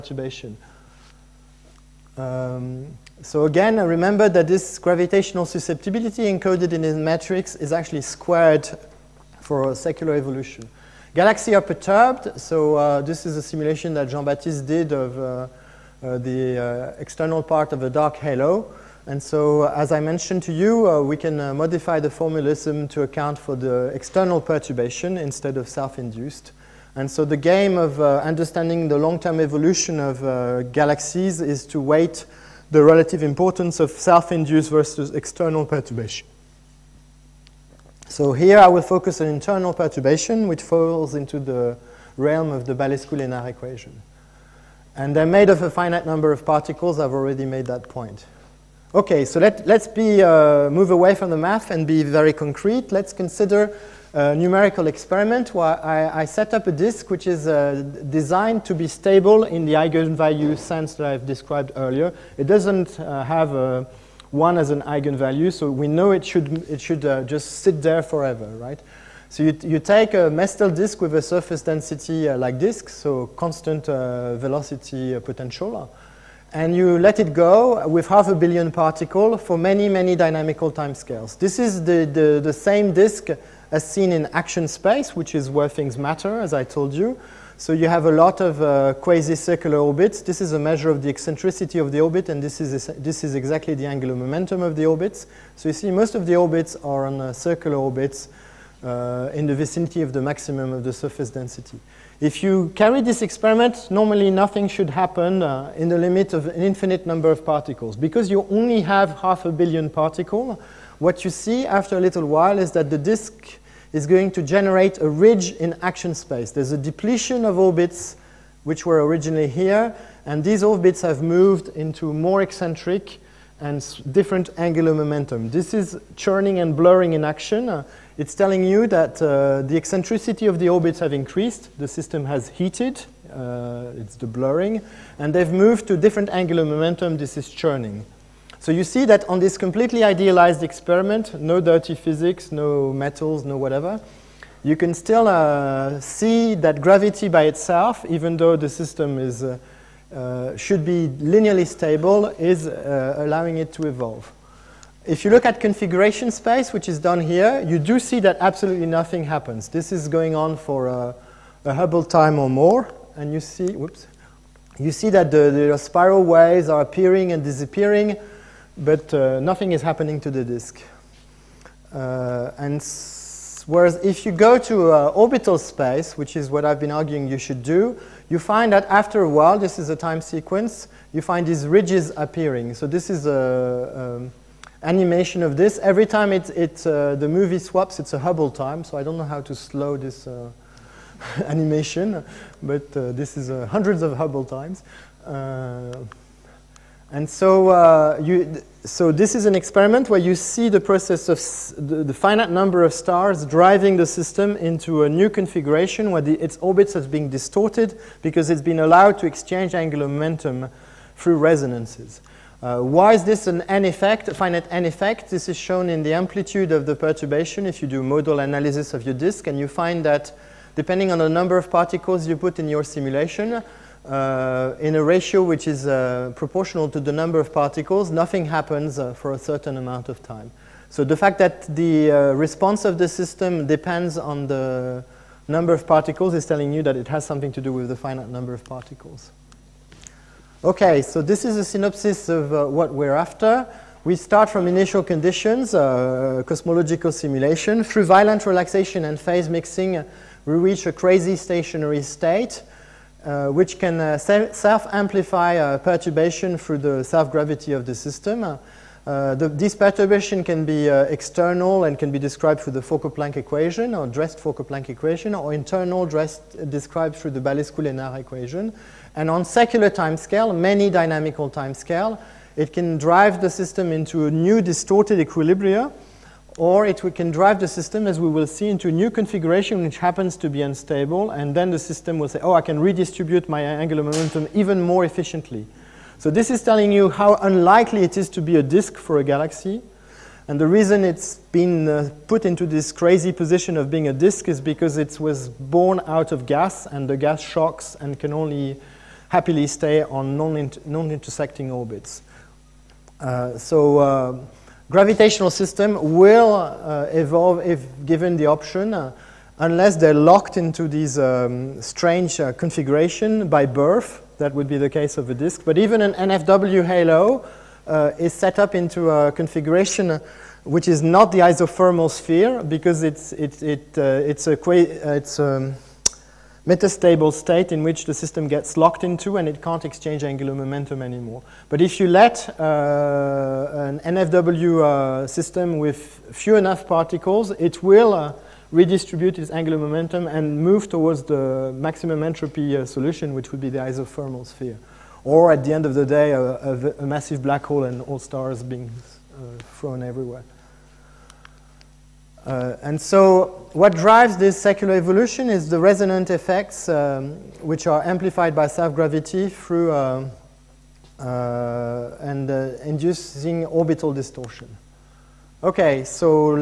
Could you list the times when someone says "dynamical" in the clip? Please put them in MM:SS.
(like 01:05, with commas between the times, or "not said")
01:20, 04:30.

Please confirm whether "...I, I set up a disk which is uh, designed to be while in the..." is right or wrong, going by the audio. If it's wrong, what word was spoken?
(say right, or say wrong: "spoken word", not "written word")
wrong: "stable", not "while".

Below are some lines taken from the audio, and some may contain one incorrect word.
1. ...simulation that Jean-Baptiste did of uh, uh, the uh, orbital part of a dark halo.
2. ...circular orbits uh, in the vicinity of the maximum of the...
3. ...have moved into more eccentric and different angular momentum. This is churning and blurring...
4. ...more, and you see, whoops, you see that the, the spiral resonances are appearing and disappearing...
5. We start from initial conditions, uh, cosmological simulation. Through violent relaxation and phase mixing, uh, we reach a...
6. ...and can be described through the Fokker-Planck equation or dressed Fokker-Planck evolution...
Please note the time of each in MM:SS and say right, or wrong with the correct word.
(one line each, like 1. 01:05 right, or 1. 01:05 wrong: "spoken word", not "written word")
1. 00:13 wrong: "external", not "orbital"
2. 01:37 right
3. 02:01 right
4. 02:42 wrong: "waves", not "resonances"
5. 04:04 right
6. 04:21 wrong: "equation", not "evolution".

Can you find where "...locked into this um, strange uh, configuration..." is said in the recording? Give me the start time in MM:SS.
05:10.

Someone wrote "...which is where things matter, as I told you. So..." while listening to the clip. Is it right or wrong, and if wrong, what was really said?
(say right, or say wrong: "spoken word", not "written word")
right.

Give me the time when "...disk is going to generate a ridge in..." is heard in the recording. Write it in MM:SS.
01:52.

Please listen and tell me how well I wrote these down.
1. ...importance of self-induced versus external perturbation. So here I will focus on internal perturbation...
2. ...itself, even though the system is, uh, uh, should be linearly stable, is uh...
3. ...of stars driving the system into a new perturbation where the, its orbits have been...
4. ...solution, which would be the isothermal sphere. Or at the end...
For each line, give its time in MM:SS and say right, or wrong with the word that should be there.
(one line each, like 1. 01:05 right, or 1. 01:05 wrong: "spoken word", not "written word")
1. 00:33 right
2. 02:27 right
3. 03:22 wrong: "configuration", not "perturbation"
4. 05:42 right.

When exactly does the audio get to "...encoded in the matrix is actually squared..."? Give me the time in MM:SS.
00:06.